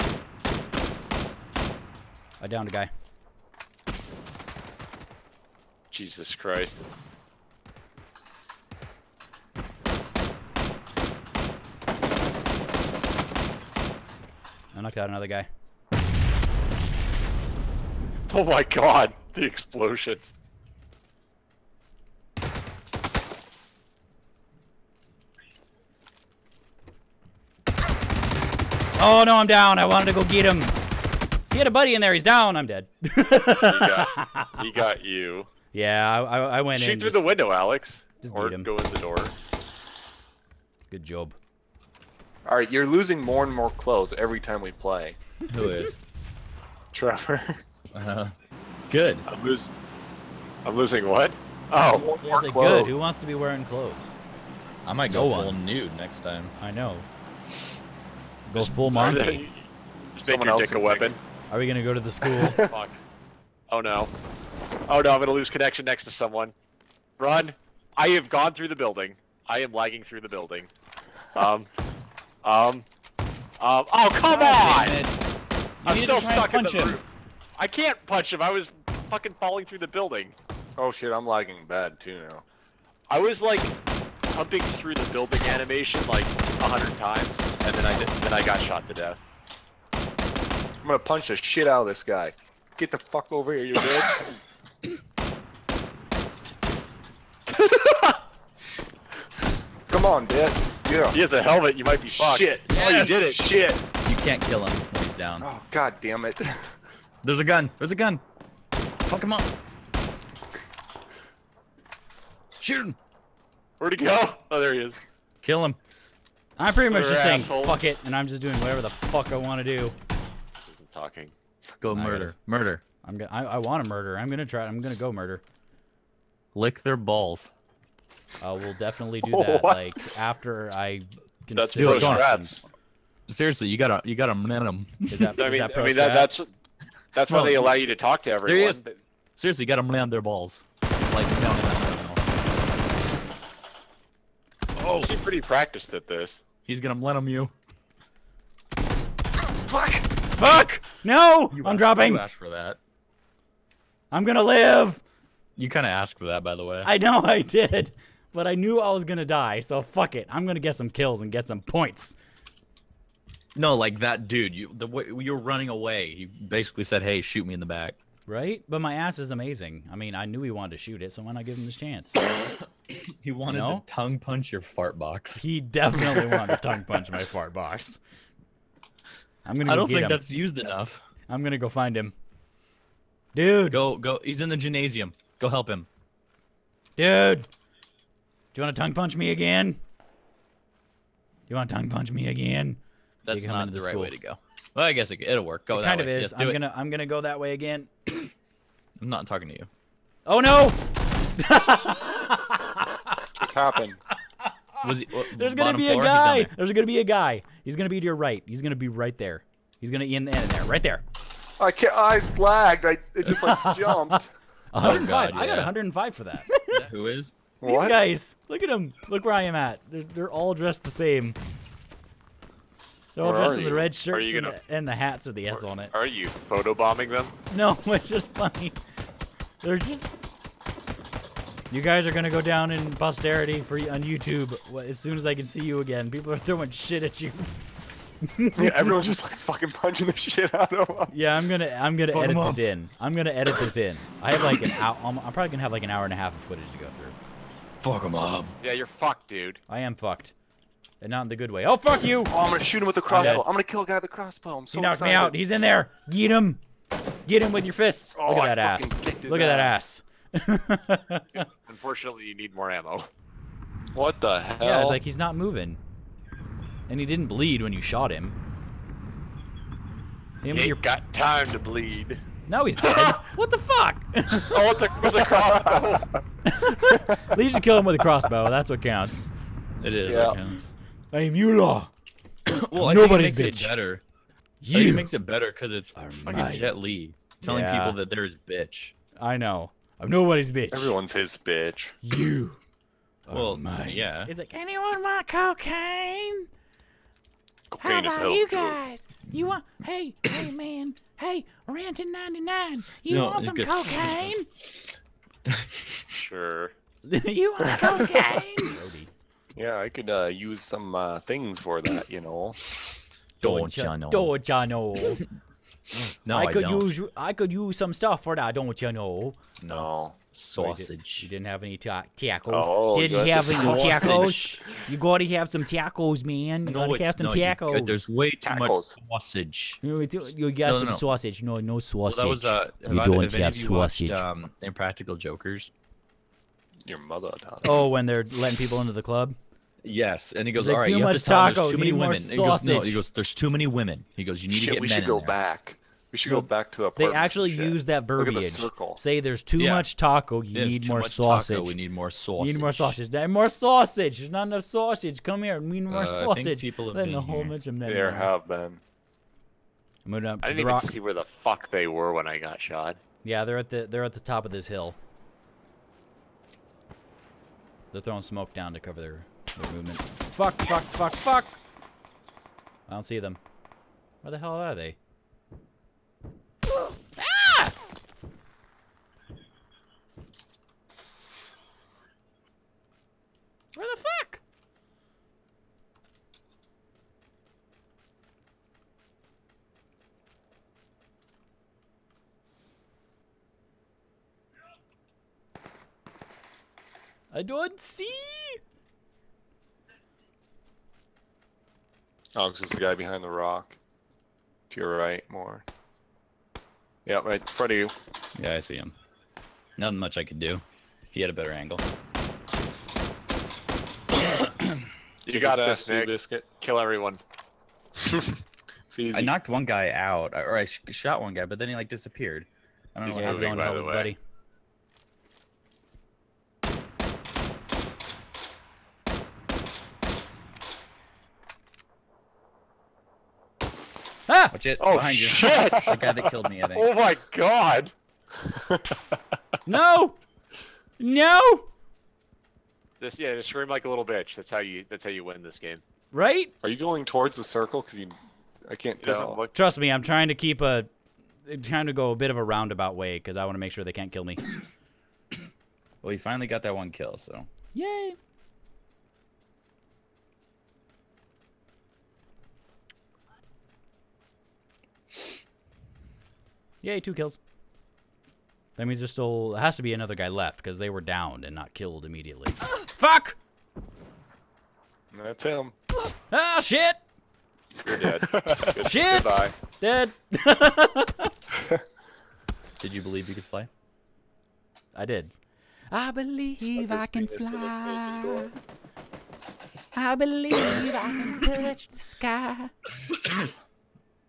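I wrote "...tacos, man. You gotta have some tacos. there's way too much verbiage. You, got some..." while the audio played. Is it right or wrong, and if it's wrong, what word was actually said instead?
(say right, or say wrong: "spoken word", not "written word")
wrong: "sausage", not "verbiage".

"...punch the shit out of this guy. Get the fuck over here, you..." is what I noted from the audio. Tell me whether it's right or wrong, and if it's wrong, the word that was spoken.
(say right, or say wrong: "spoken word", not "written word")
right.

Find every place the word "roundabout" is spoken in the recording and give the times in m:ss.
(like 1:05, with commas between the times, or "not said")
7:32.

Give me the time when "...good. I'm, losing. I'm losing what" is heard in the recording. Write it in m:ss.
0:48.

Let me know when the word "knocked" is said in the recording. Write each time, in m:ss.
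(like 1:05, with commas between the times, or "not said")
0:14, 4:14, 6:59.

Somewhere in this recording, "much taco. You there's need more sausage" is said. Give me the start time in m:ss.
5:49.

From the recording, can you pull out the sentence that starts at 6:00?
see where the fuck they were when I got shot.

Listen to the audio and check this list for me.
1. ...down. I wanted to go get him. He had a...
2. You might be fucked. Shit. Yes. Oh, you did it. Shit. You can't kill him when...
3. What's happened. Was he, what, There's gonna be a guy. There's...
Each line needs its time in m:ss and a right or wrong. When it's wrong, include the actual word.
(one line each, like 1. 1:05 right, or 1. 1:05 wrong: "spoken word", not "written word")
1. 0:29 right
2. 1:41 right
3. 3:23 right.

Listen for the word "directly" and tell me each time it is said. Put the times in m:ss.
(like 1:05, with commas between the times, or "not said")
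not said.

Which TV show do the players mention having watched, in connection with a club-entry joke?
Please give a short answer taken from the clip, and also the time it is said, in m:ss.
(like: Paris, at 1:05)
Impractical Jokers, at 5:34.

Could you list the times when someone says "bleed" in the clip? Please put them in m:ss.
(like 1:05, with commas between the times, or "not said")
4:27, 4:31.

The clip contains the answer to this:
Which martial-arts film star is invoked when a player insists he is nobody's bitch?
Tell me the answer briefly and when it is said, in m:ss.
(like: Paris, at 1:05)
Jet Li, at 4:46.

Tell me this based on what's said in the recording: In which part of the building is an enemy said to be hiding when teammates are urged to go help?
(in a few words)
the gymnasium.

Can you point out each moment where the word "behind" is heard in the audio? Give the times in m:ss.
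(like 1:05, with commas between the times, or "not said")
6:42, 7:14.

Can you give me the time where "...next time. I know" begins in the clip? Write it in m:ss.
0:55.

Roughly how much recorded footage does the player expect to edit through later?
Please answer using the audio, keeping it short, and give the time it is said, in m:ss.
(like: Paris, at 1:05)
an hour and a half, at 4:05.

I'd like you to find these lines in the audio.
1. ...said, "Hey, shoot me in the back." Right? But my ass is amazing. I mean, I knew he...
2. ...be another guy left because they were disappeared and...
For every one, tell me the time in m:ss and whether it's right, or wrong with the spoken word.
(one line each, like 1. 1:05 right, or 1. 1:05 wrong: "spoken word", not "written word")
1. 2:46 right
2. 7:49 wrong: "downed", not "disappeared".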